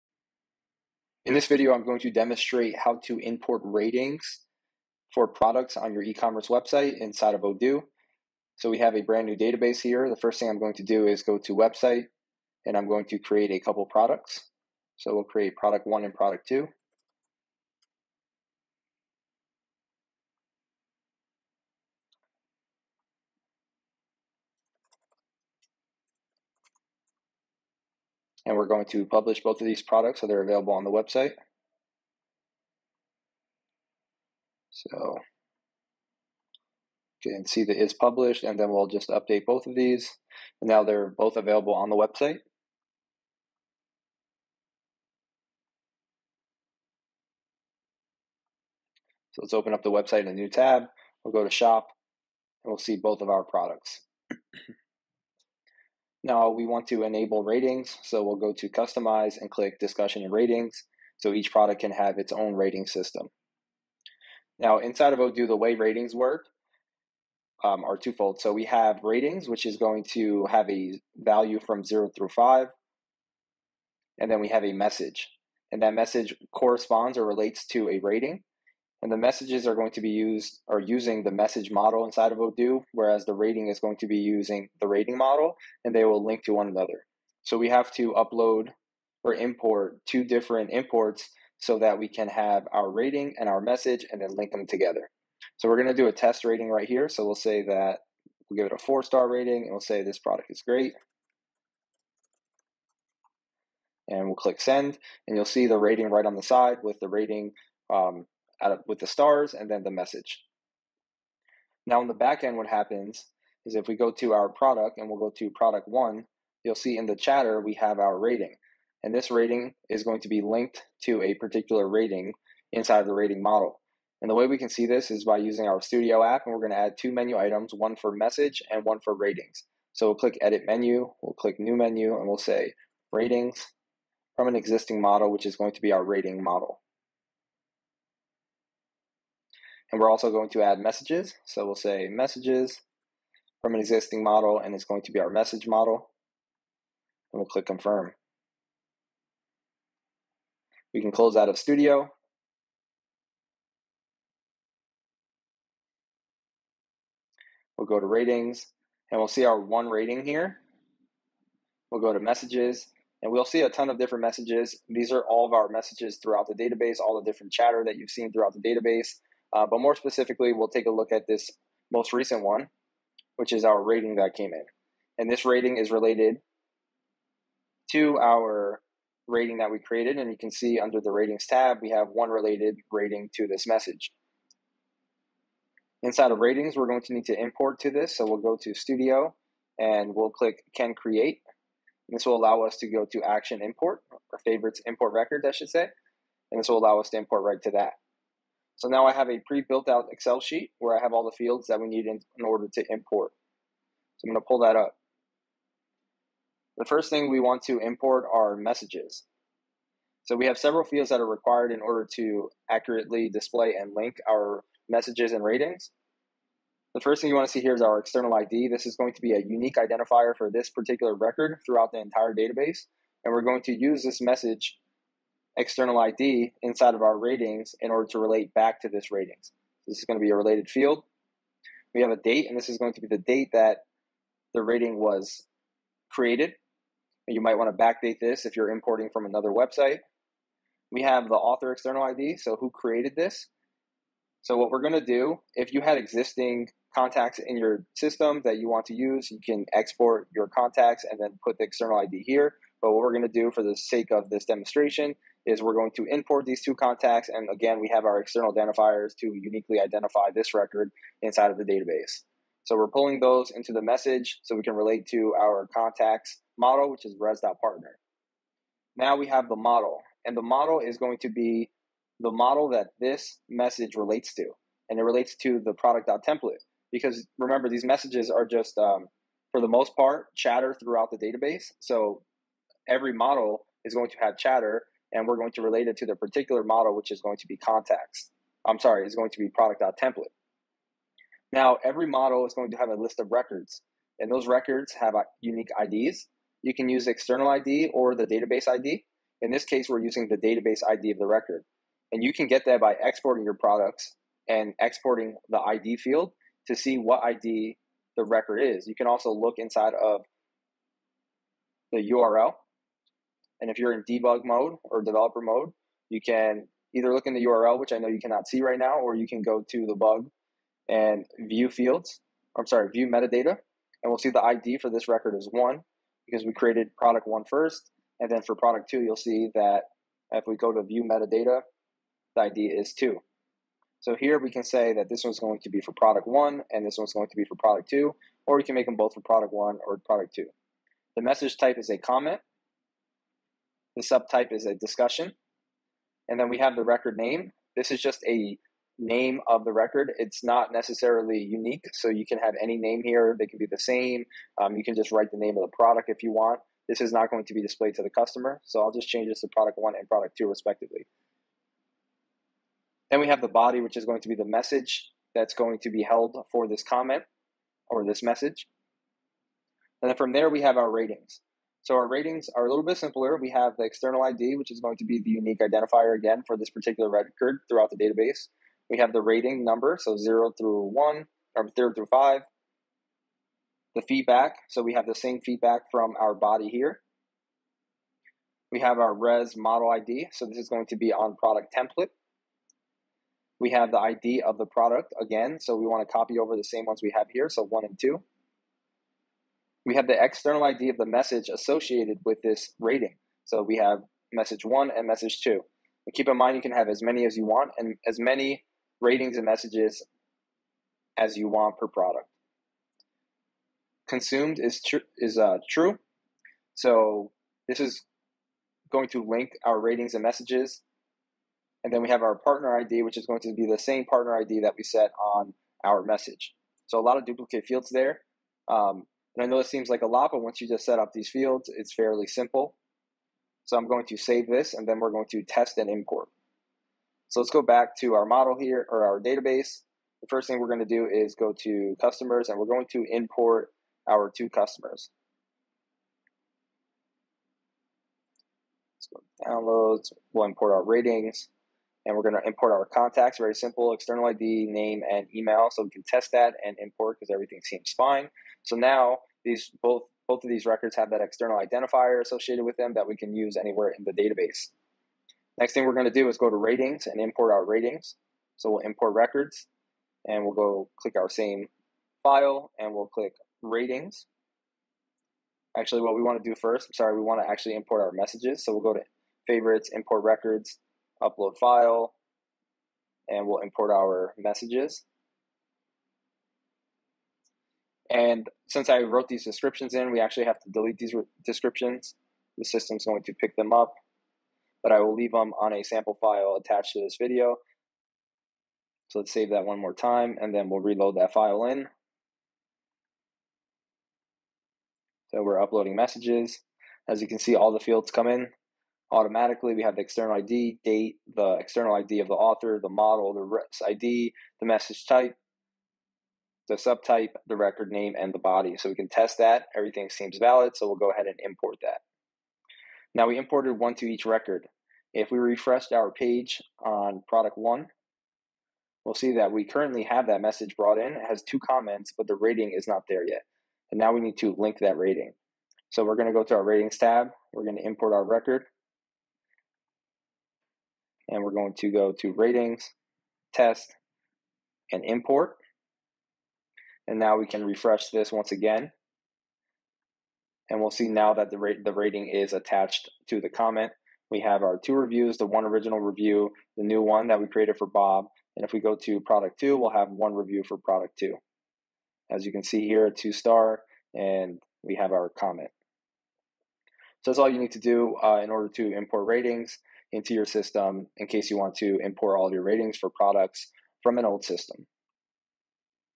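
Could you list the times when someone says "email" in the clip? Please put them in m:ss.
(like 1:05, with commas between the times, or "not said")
7:35.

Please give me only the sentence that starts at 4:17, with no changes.
And again, we have our external identifiers to uniquely identify this record inside of the database.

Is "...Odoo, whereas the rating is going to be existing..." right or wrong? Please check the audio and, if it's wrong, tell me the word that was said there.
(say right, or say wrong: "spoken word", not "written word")
wrong: "using", not "existing".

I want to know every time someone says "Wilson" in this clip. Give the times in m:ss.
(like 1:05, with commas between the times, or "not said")
not said.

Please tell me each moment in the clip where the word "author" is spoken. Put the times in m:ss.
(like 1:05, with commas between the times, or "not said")
4:01, 8:32.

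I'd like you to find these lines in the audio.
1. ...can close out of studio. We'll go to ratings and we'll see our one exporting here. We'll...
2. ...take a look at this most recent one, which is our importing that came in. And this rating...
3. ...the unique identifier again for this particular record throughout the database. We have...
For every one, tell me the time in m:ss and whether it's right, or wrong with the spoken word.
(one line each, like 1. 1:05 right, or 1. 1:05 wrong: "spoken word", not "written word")
1. 2:31 wrong: "rating", not "exporting"
2. 2:50 wrong: "rating", not "importing"
3. 6:15 right.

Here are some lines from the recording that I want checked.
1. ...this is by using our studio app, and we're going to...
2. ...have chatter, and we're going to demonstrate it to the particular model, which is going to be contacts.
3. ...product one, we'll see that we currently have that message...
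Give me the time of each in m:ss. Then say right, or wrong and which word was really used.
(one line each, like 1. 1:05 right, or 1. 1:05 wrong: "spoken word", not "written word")
1. 2:04 right
2. 4:44 wrong: "relate", not "demonstrate"
3. 8:47 right.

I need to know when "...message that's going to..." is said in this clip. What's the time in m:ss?
6:04.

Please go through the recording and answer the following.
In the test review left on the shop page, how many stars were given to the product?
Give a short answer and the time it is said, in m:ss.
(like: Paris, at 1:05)
4, at 1:38.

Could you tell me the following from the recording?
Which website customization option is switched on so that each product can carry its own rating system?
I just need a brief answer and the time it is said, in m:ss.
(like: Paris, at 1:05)
Discussion and ratings, at 0:59.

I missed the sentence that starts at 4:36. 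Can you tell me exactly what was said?
Because remember, these messages are just, um, for the most part, chatter throughout the database.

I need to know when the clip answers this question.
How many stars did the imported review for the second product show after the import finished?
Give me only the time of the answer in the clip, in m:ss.
9:23.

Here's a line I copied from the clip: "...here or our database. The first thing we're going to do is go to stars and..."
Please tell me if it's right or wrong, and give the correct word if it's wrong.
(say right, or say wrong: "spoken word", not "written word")
wrong: "customers", not "stars".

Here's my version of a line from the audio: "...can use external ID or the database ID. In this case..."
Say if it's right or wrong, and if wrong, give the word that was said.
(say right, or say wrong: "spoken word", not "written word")
right.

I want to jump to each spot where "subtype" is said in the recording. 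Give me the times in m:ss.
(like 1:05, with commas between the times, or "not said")
5:44, 8:36.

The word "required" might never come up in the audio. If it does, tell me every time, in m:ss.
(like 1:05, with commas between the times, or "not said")
3:31.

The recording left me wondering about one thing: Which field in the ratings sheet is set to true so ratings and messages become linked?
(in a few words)
Consumed.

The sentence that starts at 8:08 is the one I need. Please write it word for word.
And since I wrote these descriptions in, we actually have to delete these descriptions.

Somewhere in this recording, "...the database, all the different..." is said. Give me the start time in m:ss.
2:46.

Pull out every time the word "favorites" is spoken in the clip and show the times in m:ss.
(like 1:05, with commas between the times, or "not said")
3:14, 7:59.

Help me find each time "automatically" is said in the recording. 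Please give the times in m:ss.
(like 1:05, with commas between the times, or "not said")
8:29.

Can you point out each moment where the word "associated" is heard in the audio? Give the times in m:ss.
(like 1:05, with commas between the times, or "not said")
6:41, 7:42.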